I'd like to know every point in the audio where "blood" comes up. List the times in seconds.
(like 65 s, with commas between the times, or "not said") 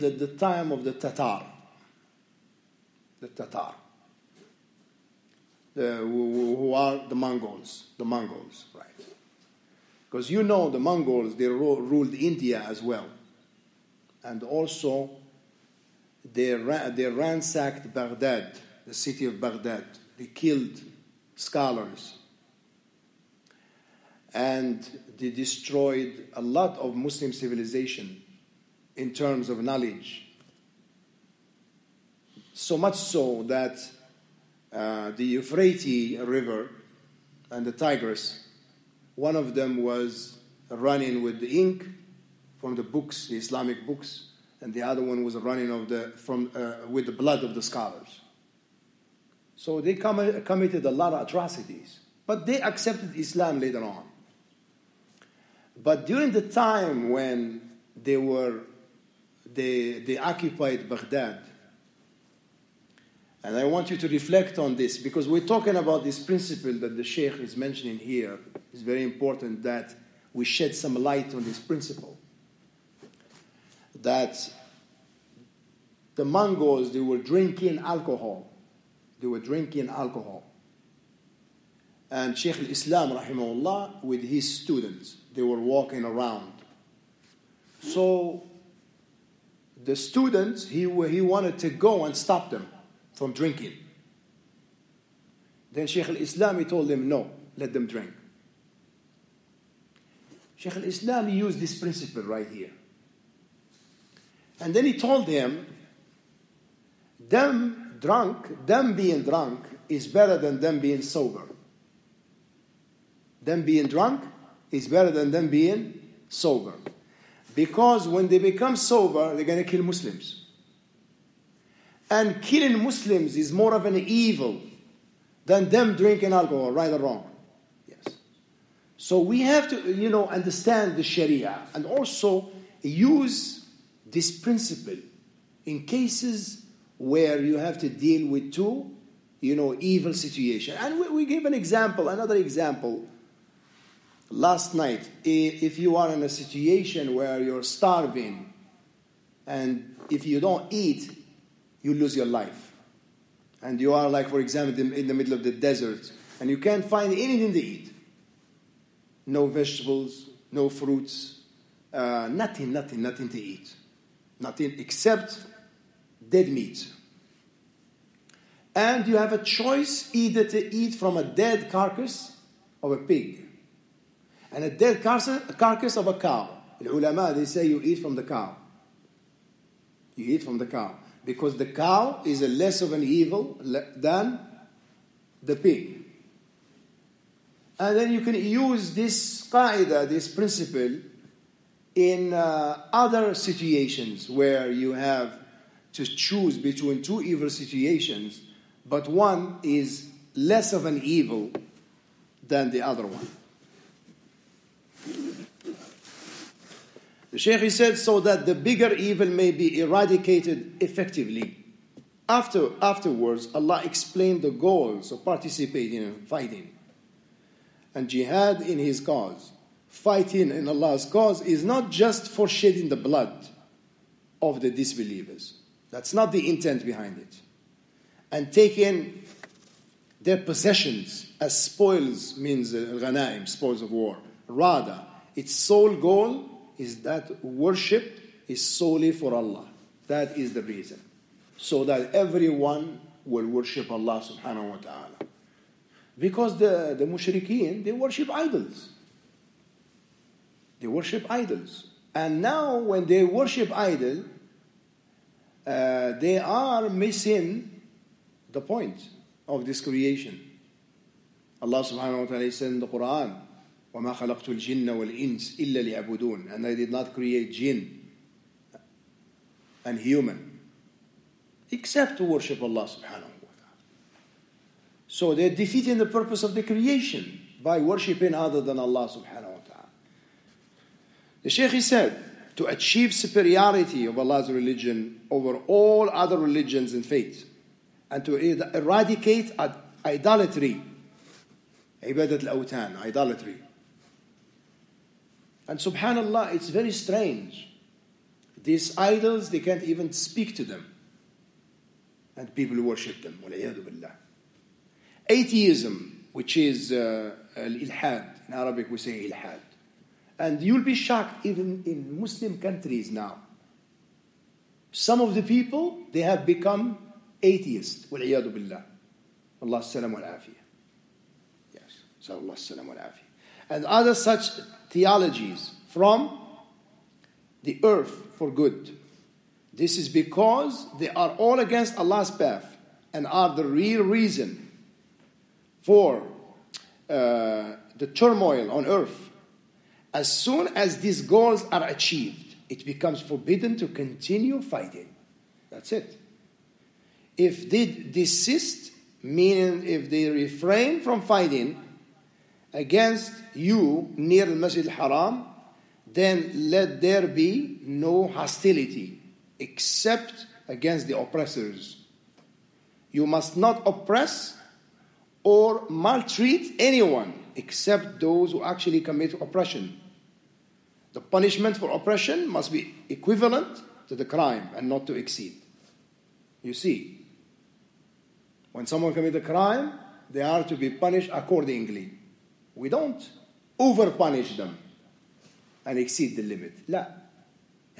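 47 s, 222 s.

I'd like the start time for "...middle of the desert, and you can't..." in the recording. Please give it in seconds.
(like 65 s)
155 s.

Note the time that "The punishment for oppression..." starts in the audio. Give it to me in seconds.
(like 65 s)
371 s.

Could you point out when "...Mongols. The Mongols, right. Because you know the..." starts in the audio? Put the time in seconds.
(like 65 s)
7 s.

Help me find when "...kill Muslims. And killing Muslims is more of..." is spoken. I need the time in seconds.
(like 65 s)
119 s.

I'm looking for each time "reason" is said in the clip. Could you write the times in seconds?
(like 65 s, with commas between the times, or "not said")
240 s, 334 s.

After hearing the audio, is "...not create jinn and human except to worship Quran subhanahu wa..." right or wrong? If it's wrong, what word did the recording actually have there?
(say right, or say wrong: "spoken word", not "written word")
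wrong: "Allah", not "Quran".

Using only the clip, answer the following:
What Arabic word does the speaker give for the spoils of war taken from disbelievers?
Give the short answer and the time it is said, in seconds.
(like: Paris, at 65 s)
ghanaim, at 232 s.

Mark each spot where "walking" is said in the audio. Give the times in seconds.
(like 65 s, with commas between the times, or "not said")
85 s.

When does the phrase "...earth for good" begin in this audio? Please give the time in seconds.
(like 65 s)
327 s.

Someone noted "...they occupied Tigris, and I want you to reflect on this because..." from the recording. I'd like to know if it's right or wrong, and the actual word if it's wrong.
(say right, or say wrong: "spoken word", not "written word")
wrong: "Baghdad", not "Tigris".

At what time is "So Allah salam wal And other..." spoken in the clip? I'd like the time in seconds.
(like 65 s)
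322 s.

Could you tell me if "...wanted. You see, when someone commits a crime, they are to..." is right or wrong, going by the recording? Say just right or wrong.
wrong.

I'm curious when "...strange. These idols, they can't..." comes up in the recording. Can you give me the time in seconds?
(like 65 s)
296 s.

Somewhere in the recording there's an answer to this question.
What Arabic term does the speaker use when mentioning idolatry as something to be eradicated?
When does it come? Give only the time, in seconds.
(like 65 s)
292 s.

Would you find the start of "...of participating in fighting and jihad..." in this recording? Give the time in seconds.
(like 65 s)
215 s.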